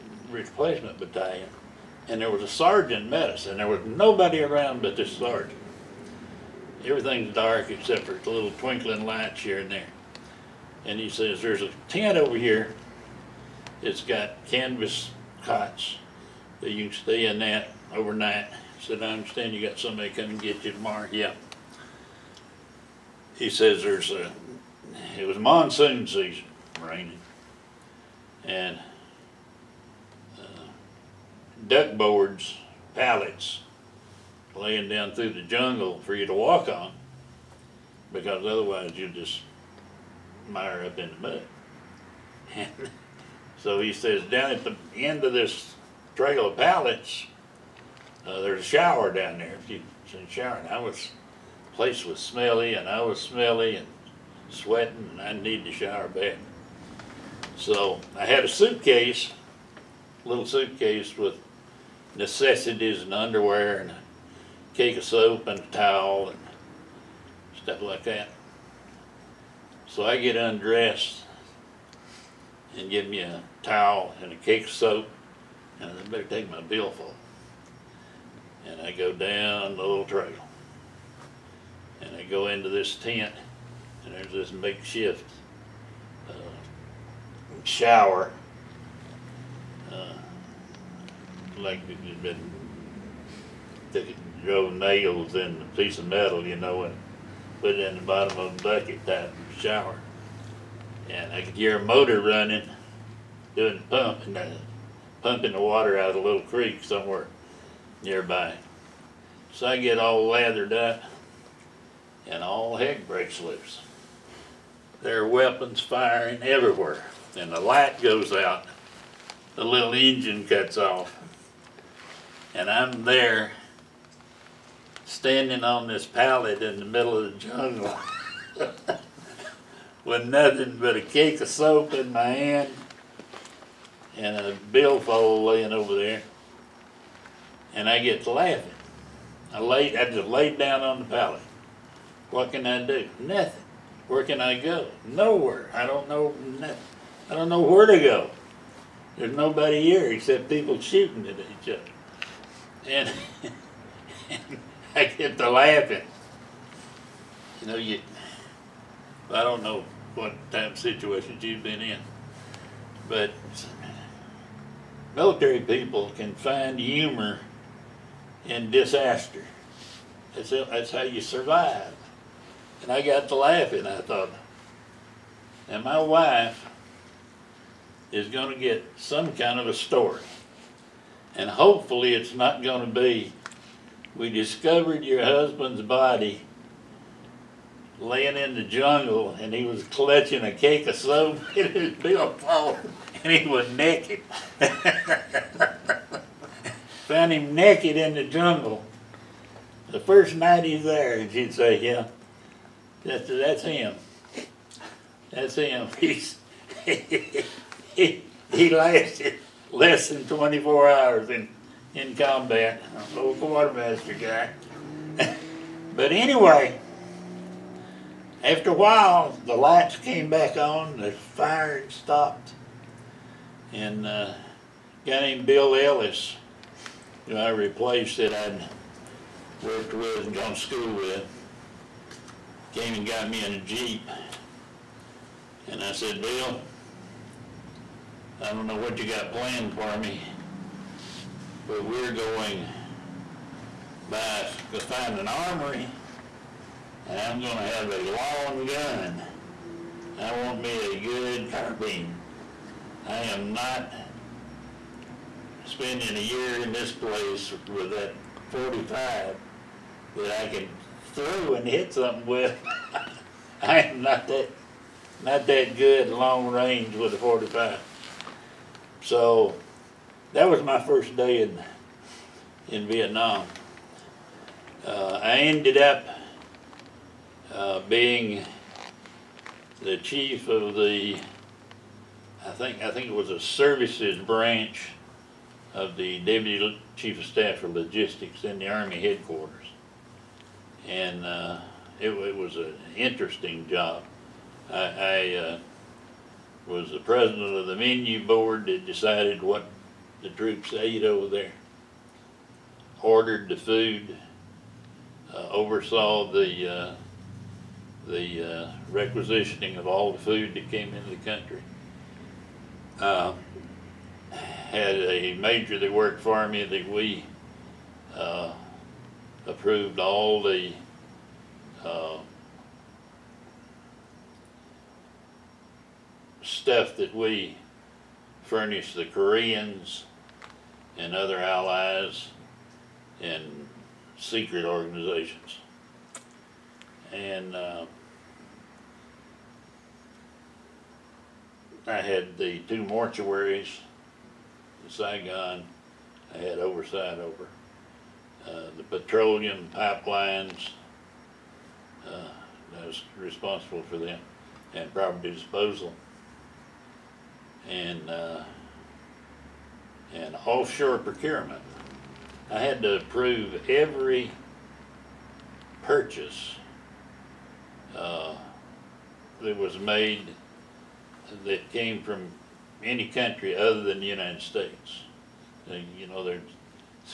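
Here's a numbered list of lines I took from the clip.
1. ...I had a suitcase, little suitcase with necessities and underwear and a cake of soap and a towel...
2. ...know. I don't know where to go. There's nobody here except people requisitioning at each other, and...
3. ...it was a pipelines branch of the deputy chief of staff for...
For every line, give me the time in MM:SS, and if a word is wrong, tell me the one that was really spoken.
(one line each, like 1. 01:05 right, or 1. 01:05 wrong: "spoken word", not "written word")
1. 00:58 right
2. 02:26 wrong: "shooting", not "requisitioning"
3. 04:43 wrong: "services", not "pipelines".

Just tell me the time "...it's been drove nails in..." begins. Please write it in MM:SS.
01:31.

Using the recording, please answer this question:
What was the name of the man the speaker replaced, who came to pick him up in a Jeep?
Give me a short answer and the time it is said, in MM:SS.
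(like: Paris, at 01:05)
Bill Ellis, at 03:45.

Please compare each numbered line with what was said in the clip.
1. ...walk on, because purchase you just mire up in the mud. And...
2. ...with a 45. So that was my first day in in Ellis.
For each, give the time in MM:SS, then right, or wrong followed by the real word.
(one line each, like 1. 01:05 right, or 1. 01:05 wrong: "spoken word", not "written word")
1. 00:36 wrong: "otherwise", not "purchase"
2. 04:26 wrong: "Vietnam", not "Ellis".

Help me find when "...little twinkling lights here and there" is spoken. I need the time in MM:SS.
00:08.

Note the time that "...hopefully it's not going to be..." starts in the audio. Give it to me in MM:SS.
03:01.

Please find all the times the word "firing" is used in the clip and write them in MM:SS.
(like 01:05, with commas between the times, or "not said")
01:55, 03:41.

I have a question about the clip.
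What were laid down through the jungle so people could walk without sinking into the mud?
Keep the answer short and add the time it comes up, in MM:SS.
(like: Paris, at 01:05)
Duck boards, at 00:31.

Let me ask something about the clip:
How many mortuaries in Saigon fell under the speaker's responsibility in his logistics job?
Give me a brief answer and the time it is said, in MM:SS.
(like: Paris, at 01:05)
2, at 05:42.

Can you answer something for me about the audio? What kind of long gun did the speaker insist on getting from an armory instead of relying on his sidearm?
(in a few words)
Carbine.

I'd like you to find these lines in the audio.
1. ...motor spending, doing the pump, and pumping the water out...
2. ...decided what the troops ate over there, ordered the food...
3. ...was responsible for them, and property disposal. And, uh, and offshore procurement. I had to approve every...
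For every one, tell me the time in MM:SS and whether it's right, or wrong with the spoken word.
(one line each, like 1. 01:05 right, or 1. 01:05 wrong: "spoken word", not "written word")
1. 01:41 wrong: "running", not "spending"
2. 04:58 right
3. 05:52 right.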